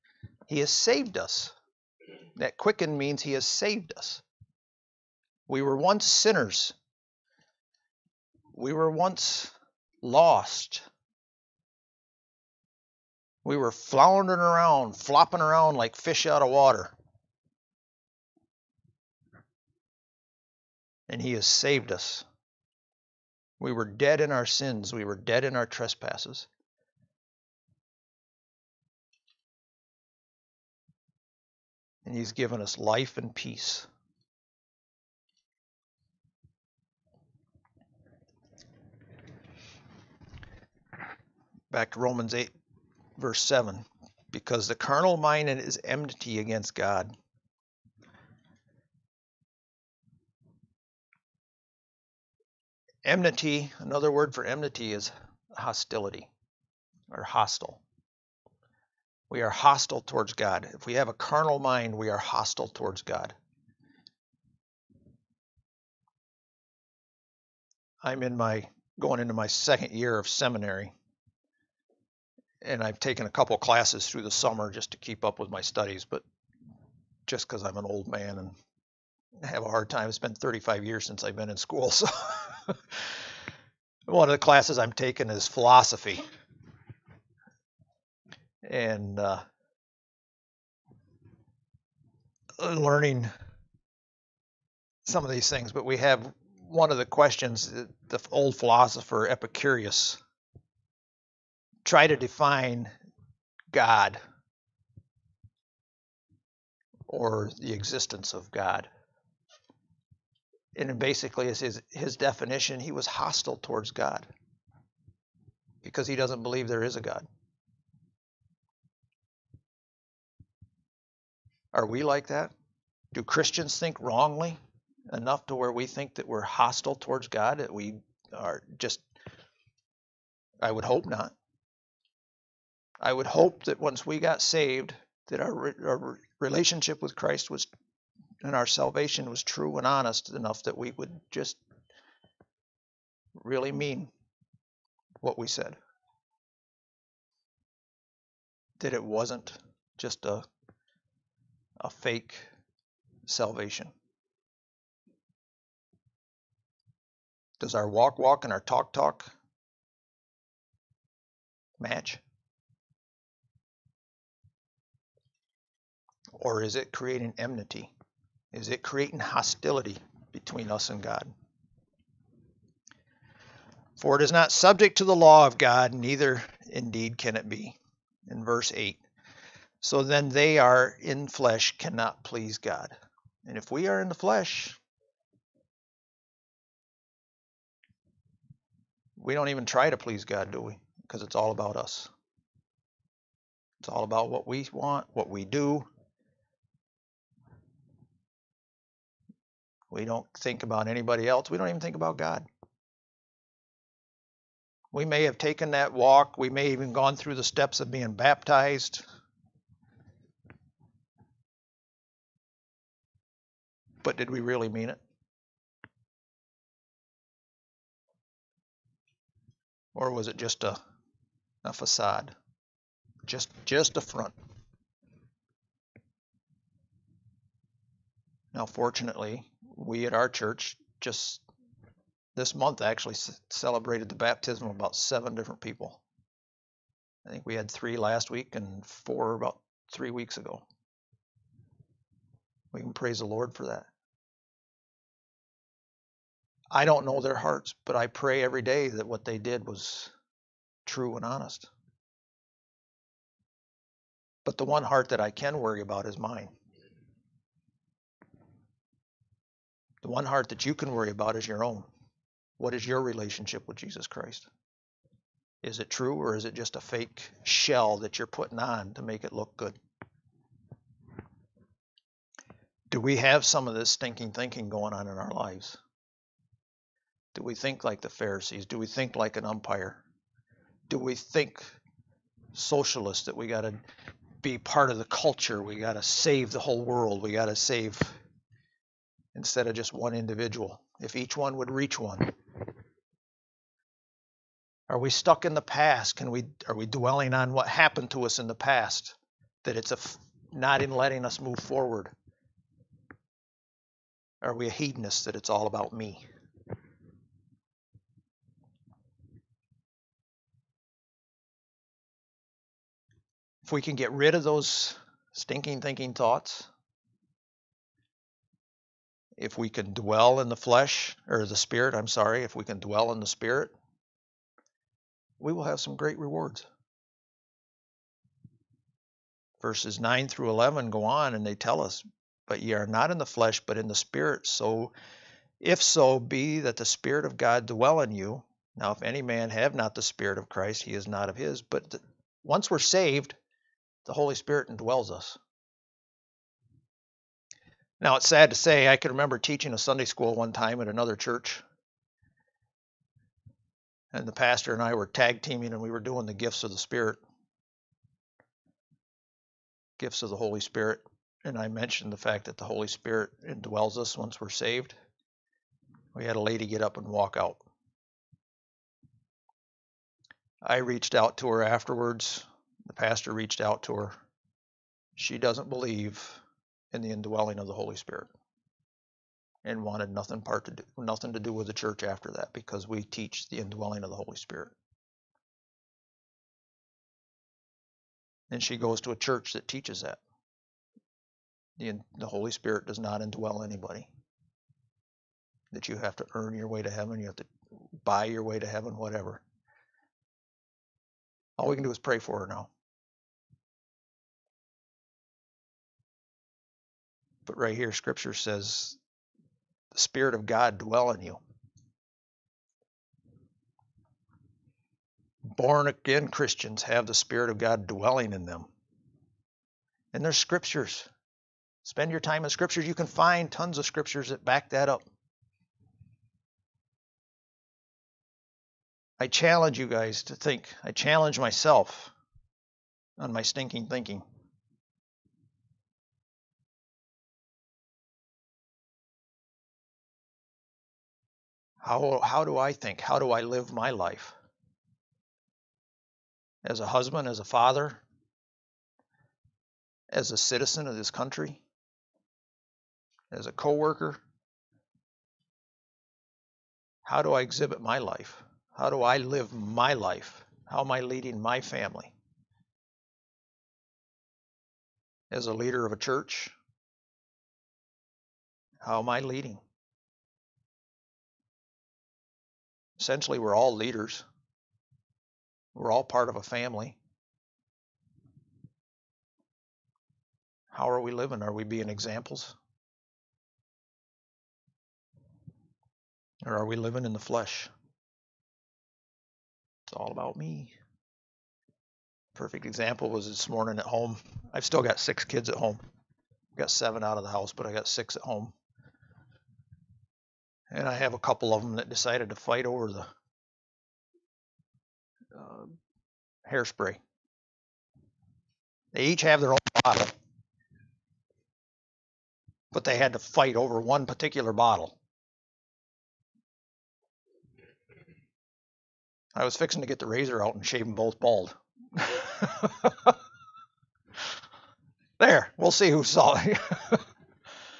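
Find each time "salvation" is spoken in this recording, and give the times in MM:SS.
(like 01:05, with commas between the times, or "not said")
02:18, 02:33.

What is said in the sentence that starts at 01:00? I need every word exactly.
If we have a carnal mind, we are hostile towards God.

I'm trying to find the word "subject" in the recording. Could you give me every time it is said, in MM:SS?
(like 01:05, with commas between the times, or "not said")
02:54.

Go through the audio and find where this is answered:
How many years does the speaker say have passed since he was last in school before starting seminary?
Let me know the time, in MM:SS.
01:20.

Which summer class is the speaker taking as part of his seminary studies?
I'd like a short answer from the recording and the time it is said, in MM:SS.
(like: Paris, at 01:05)
philosophy, at 01:25.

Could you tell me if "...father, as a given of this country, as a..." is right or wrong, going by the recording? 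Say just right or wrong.
wrong.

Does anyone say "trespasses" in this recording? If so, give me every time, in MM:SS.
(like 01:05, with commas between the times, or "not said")
00:25.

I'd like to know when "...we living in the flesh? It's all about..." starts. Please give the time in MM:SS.
08:06.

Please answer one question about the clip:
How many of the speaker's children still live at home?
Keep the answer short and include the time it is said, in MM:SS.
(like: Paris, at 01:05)
6, at 08:14.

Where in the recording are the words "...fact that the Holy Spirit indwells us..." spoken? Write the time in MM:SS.
06:02.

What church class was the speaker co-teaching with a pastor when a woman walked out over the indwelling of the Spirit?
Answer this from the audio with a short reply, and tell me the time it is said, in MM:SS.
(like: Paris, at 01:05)
Sunday school, at 05:49.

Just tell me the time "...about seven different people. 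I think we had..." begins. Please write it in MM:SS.
03:54.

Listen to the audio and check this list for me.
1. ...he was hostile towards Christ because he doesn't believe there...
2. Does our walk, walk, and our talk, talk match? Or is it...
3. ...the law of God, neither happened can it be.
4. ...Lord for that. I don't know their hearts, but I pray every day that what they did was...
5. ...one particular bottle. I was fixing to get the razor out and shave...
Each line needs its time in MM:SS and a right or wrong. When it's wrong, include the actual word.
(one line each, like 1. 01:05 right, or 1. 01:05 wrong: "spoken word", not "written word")
1. 01:52 wrong: "God", not "Christ"
2. 02:37 right
3. 02:55 wrong: "indeed", not "happened"
4. 04:03 right
5. 08:33 right.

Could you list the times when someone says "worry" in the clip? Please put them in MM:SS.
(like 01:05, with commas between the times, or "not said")
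04:15, 04:20.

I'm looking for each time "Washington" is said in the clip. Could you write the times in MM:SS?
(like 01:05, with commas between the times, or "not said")
not said.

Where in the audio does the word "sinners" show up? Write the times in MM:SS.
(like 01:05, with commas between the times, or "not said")
00:06.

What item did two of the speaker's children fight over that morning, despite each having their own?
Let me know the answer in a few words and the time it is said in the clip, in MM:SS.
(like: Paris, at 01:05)
hairspray, at 08:26.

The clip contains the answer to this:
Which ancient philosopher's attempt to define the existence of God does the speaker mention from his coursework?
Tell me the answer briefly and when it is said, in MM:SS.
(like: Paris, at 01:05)
Epicurus, at 01:39.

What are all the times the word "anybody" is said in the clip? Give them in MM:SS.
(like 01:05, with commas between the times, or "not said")
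03:20, 06:33.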